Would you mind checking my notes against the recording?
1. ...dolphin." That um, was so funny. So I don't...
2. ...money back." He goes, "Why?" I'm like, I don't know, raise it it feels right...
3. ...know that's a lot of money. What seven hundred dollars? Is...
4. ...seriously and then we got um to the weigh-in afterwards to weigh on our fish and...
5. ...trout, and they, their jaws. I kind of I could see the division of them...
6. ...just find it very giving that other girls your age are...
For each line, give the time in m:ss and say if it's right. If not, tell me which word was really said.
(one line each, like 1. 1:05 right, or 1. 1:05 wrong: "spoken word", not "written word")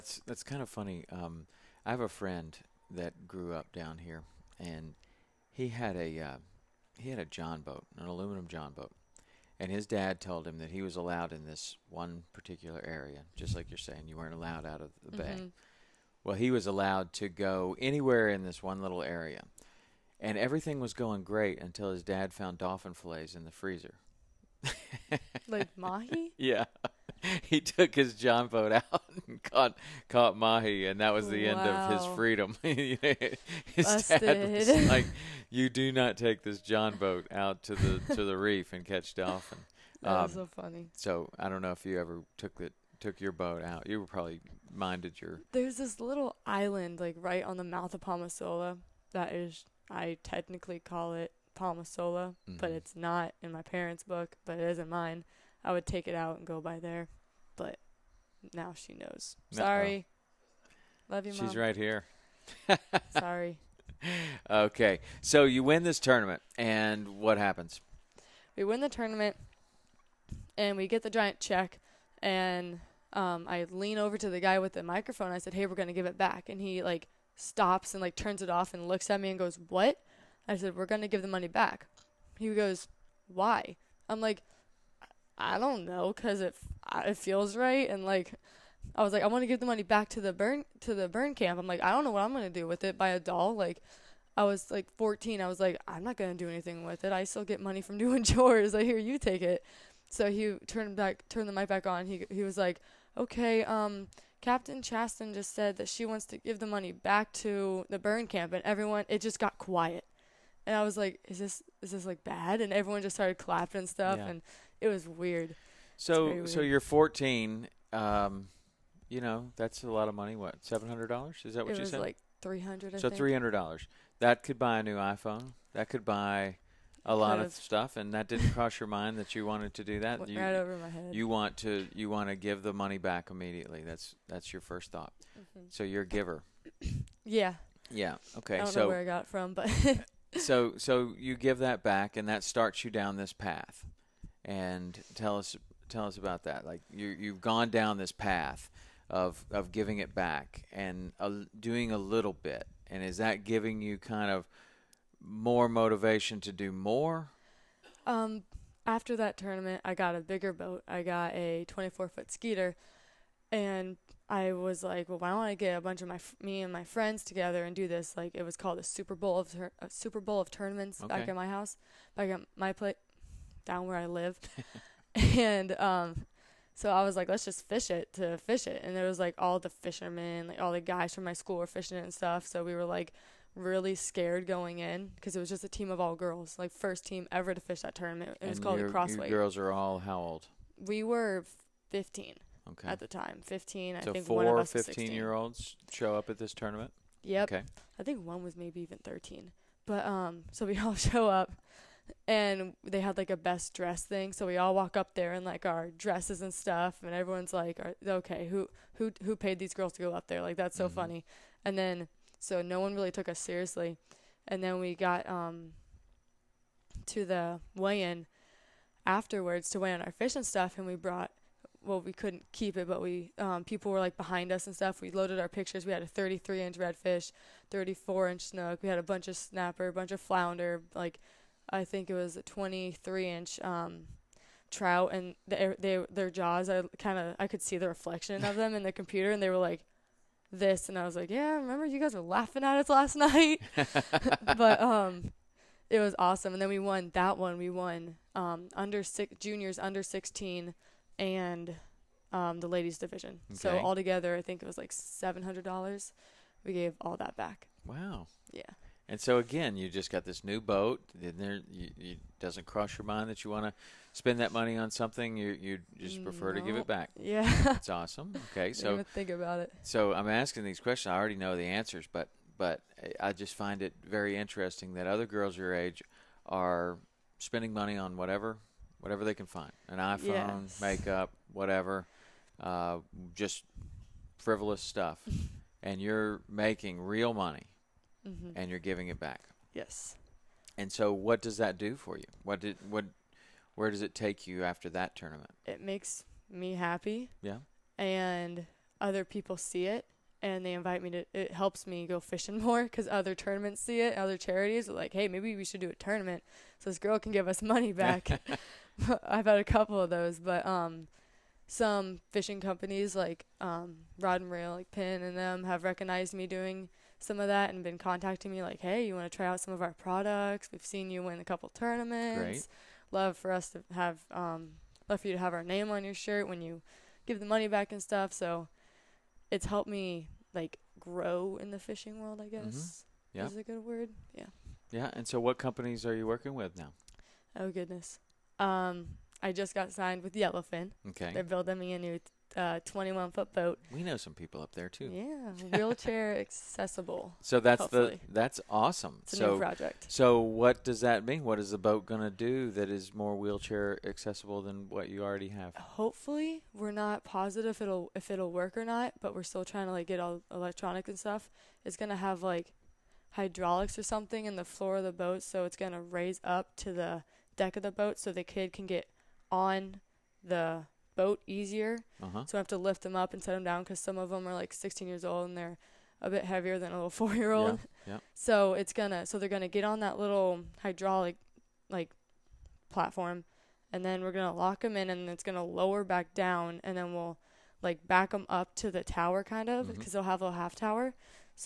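1. 0:39 right
2. 1:21 wrong: "cause", not "raise"
3. 1:59 right
4. 3:33 right
5. 3:54 wrong: "reflection", not "division"
6. 4:33 wrong: "interesting", not "giving".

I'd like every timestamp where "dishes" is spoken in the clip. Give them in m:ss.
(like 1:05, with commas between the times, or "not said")
not said.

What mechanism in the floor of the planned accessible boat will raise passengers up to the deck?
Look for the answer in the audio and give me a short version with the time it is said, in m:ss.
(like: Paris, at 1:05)
Hydraulics, at 6:03.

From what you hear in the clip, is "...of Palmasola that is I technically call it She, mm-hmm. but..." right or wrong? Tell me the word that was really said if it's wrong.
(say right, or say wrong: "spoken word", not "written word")
wrong: "Palmasola", not "She".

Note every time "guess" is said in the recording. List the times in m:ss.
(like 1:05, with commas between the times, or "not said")
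5:32.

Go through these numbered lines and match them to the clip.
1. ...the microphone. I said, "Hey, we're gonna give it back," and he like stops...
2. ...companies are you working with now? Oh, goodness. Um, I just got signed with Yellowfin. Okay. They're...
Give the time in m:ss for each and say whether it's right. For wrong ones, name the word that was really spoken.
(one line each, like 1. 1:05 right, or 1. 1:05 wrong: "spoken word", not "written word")
1. 1:14 right
2. 5:35 right.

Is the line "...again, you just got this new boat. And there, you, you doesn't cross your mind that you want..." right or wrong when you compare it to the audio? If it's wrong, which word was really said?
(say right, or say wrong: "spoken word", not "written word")
right.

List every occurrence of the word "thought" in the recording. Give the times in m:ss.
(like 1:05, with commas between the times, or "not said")
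2:14.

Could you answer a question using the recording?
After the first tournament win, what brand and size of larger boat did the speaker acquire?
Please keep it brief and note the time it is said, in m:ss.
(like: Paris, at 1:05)
24 foot Skeeter, at 2:41.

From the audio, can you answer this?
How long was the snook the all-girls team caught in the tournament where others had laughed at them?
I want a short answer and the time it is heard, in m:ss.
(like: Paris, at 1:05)
34 inches, at 3:47.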